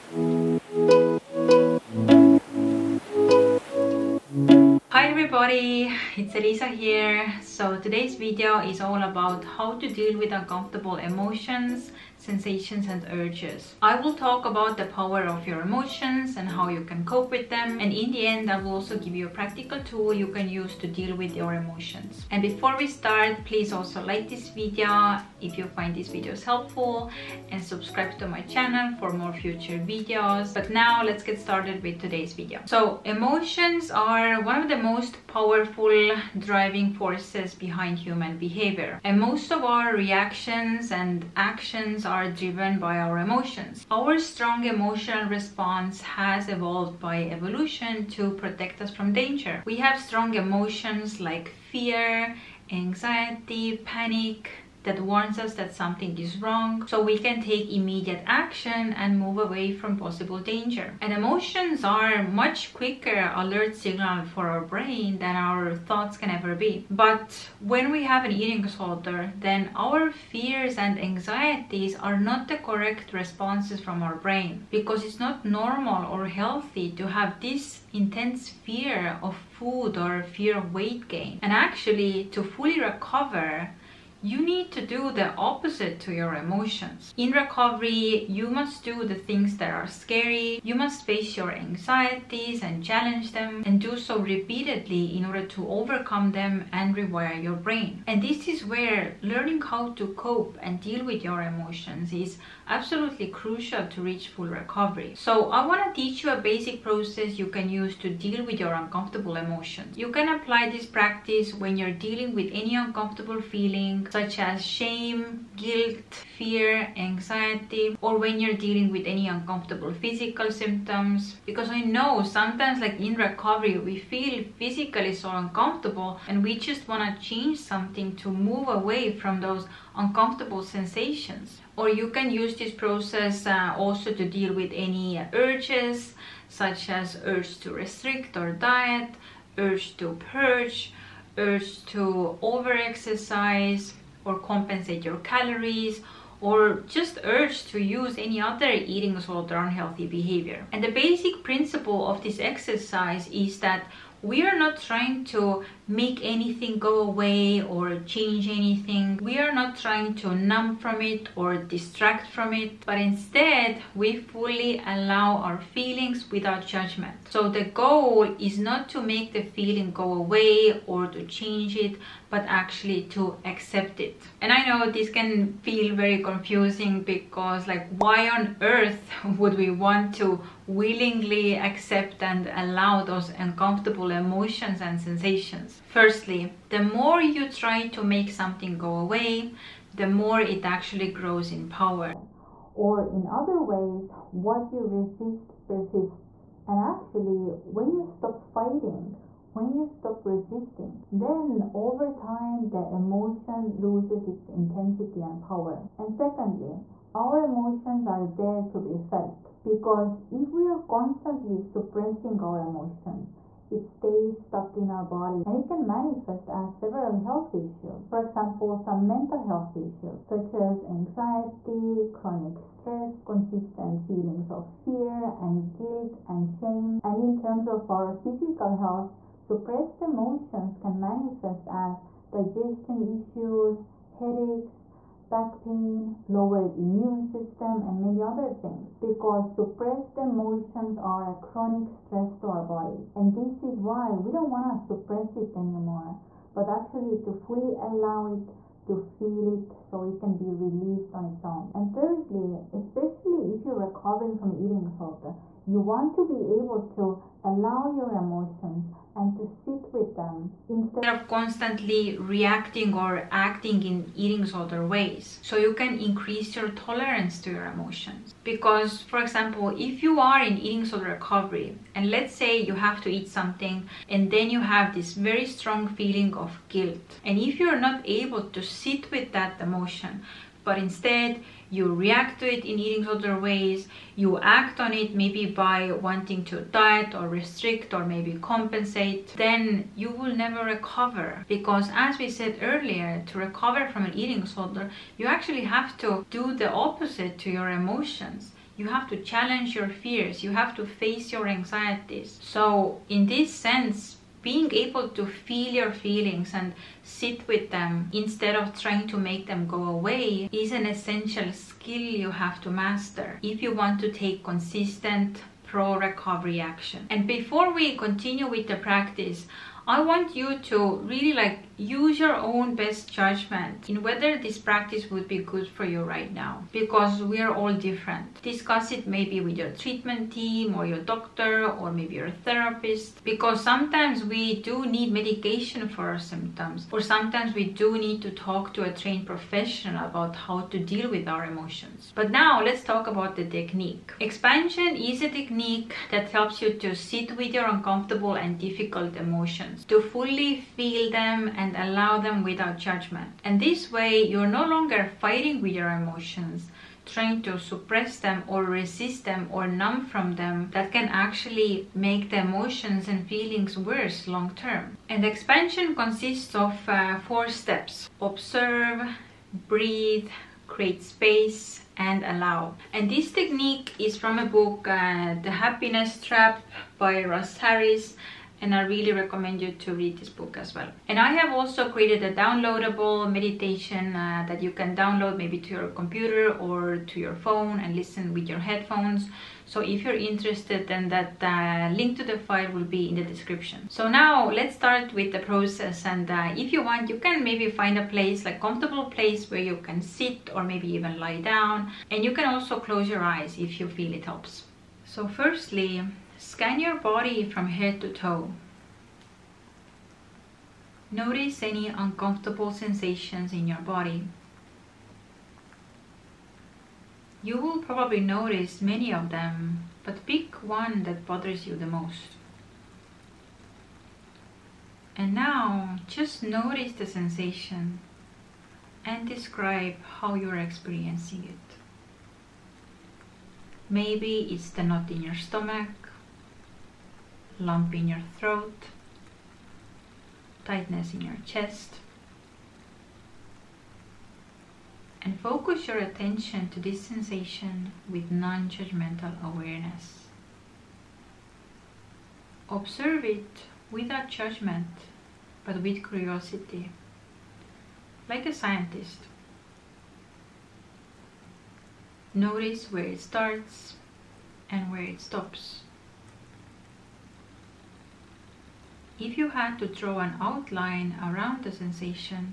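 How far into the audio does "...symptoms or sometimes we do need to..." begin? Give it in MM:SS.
05:36.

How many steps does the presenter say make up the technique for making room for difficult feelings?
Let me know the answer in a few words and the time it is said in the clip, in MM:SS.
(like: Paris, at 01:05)
4, at 06:07.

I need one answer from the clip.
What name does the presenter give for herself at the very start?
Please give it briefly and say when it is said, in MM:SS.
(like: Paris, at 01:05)
Elisa, at 00:06.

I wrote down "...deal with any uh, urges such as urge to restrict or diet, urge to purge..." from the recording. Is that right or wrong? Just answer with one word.
right.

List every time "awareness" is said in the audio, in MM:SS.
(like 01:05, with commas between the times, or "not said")
07:29.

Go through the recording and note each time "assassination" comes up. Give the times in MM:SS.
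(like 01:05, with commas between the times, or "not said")
not said.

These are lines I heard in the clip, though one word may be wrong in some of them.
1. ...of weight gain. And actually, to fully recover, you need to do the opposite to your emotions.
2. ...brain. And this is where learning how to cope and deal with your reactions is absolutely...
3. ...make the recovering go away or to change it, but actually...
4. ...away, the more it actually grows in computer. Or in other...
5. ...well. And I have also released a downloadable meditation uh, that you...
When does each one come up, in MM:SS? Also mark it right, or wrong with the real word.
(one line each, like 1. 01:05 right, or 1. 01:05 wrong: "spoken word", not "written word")
1. 01:20 right
2. 01:37 wrong: "emotions", not "reactions"
3. 02:49 wrong: "feeling", not "recovering"
4. 03:08 wrong: "power", not "computer"
5. 06:20 wrong: "created", not "released".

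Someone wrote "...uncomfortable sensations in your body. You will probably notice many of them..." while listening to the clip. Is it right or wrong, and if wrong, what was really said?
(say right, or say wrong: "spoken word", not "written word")
right.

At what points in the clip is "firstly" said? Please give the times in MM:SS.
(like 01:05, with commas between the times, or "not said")
03:05, 06:45.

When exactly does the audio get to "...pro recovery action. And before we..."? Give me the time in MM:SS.
05:15.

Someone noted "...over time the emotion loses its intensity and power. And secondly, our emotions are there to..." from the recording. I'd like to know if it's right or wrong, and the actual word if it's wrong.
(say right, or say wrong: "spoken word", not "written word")
right.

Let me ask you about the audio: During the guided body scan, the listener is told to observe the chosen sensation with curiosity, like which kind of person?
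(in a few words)
a scientist.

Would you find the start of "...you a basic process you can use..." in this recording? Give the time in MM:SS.
01:46.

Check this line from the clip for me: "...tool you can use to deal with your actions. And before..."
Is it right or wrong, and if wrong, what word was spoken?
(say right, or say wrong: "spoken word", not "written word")
wrong: "emotions", not "actions".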